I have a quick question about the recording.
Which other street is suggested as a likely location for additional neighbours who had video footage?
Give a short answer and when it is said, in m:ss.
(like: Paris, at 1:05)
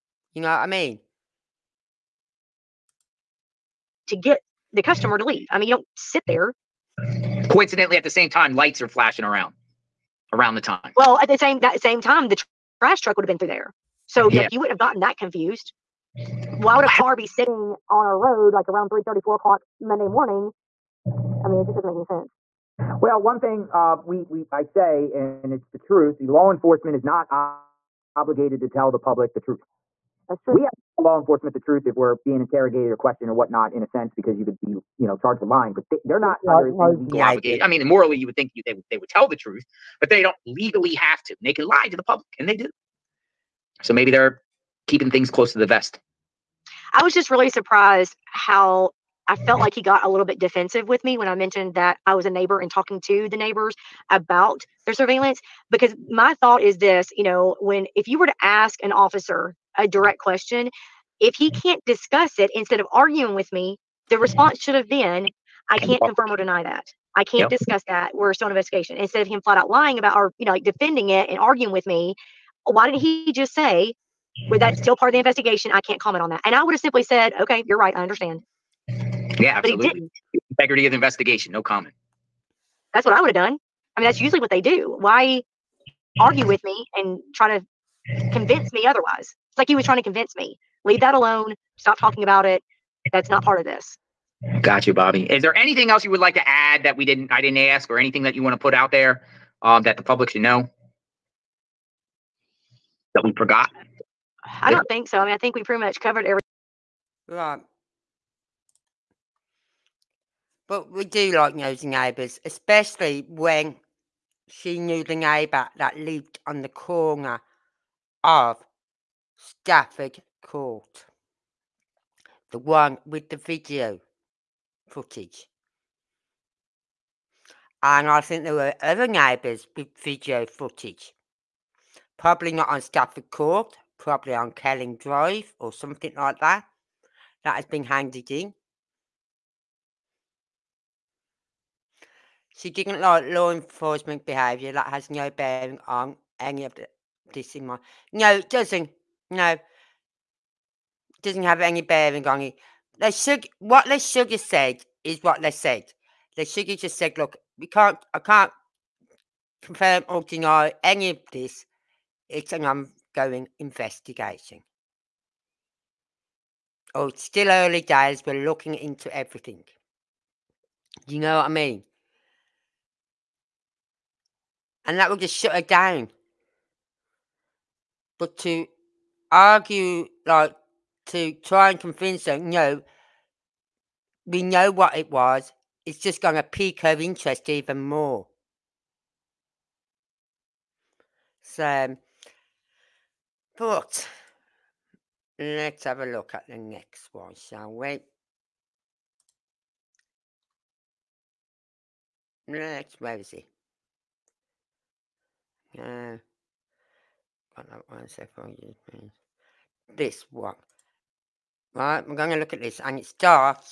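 Kelling Drive, at 2:14.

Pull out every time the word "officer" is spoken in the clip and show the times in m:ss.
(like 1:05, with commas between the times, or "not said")
0:58.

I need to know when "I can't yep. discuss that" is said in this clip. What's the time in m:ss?
1:07.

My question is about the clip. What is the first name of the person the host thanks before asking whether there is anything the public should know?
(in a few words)
Bobby.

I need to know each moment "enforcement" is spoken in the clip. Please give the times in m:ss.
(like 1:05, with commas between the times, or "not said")
0:26, 0:31, 2:23.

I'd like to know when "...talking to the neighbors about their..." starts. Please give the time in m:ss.
0:52.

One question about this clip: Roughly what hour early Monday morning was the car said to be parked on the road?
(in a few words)
3 or 4 o'clock.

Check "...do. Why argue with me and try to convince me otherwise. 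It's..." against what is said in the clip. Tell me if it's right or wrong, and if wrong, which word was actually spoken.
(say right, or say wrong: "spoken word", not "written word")
right.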